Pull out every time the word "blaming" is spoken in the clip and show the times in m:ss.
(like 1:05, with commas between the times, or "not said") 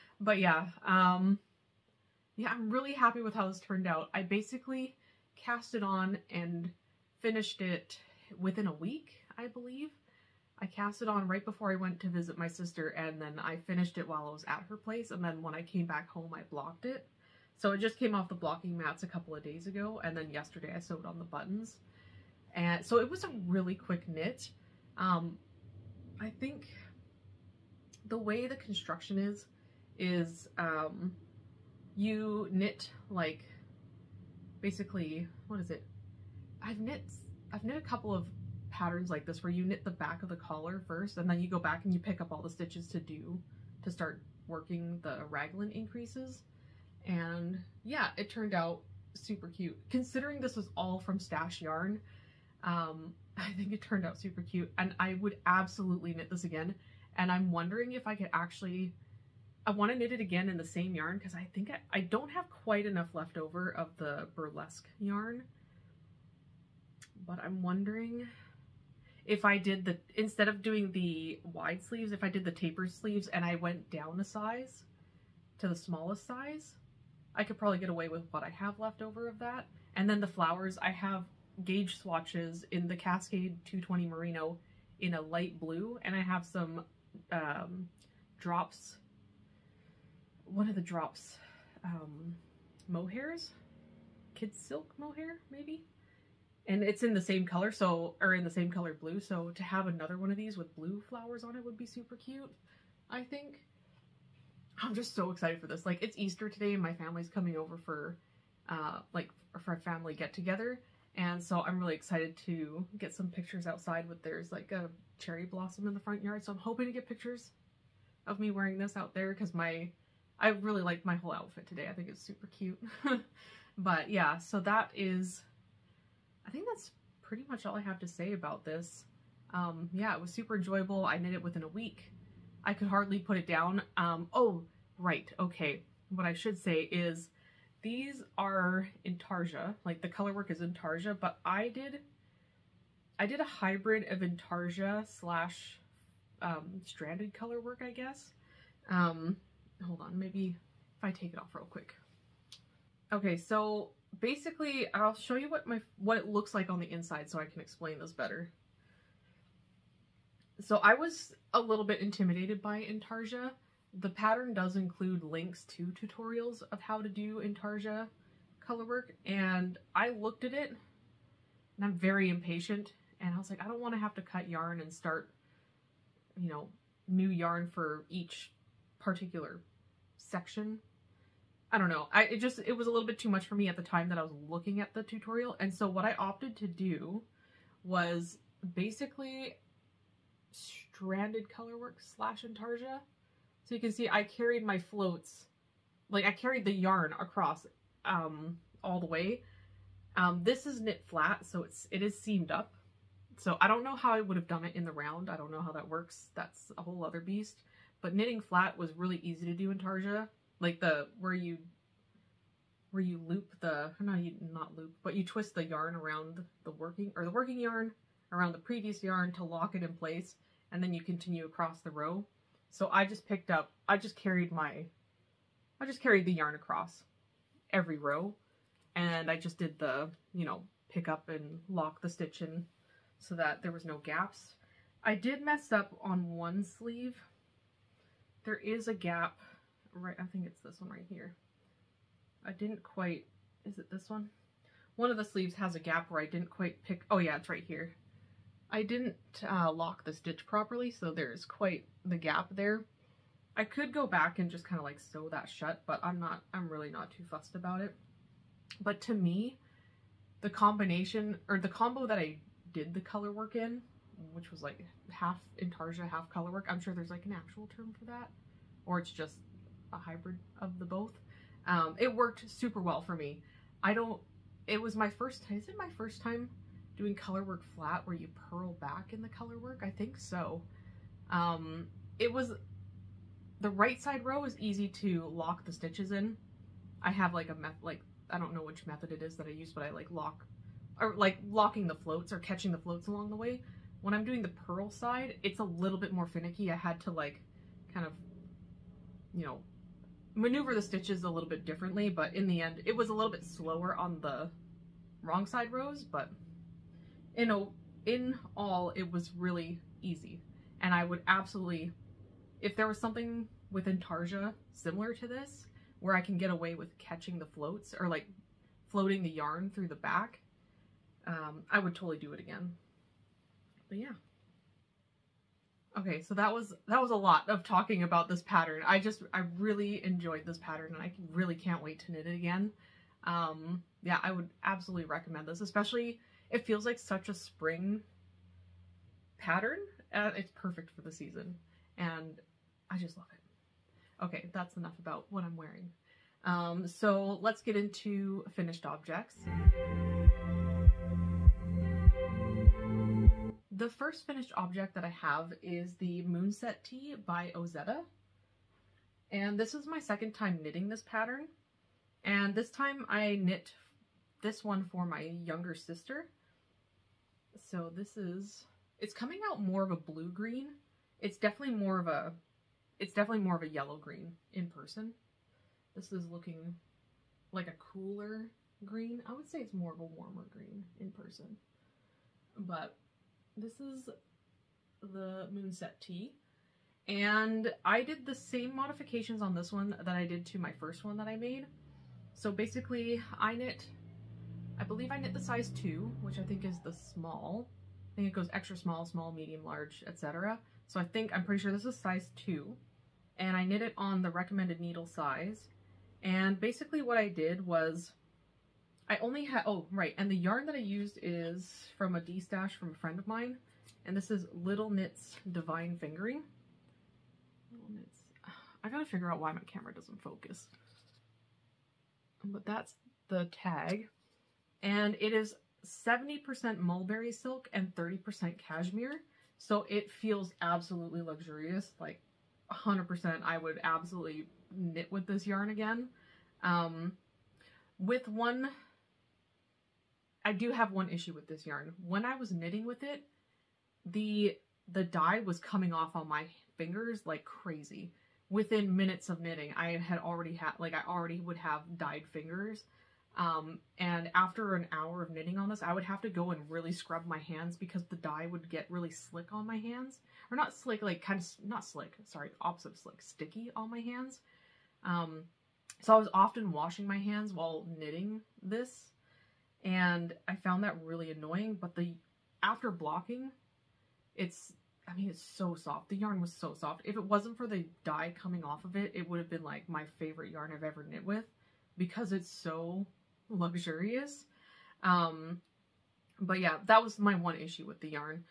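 not said.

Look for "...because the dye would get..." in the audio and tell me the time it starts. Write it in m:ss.
7:37.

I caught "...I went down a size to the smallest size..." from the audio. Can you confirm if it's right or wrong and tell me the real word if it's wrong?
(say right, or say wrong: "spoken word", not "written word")
right.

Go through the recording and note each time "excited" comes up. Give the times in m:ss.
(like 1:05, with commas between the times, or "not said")
1:45, 1:51.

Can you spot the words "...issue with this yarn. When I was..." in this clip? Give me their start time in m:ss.
7:21.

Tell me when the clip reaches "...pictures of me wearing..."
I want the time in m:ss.
1:57.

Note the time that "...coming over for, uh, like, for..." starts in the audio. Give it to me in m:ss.
1:47.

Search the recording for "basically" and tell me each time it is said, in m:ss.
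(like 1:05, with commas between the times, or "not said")
0:04, 0:34, 2:34, 3:08, 6:32, 6:46.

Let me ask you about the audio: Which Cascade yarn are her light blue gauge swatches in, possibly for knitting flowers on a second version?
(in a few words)
Cascade 220 Merino.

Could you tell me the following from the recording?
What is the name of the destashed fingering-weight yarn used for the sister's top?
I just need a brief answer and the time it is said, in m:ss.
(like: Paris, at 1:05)
Little Knits Divine Fingering, at 6:54.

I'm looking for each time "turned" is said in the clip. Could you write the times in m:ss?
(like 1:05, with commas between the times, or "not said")
0:03, 0:48, 0:53.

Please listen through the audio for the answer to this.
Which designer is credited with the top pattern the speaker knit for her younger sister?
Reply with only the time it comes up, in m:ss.
5:57.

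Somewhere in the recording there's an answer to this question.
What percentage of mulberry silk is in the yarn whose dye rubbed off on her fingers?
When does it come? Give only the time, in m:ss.
7:05.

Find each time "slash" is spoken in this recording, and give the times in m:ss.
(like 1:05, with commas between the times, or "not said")
2:25, 3:11.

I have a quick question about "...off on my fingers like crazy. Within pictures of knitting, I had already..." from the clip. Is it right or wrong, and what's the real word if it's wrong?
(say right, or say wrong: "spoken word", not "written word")
wrong: "minutes", not "pictures".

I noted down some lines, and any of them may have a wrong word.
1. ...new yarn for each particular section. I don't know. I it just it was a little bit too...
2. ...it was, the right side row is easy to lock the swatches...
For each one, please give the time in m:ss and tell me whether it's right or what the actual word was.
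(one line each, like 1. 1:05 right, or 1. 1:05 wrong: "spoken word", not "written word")
1. 2:57 right
2. 4:42 wrong: "stitches", not "swatches".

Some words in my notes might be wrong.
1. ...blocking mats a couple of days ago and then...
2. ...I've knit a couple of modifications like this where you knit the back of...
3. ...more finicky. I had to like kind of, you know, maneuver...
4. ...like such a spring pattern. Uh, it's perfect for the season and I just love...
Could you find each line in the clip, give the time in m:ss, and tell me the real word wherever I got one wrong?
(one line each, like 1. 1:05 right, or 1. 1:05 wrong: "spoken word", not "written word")
1. 0:18 right
2. 0:37 wrong: "patterns", not "modifications"
3. 4:56 right
4. 5:36 right.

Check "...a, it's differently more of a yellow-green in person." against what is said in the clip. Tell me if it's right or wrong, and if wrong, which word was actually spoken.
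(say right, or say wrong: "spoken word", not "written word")
wrong: "definitely", not "differently".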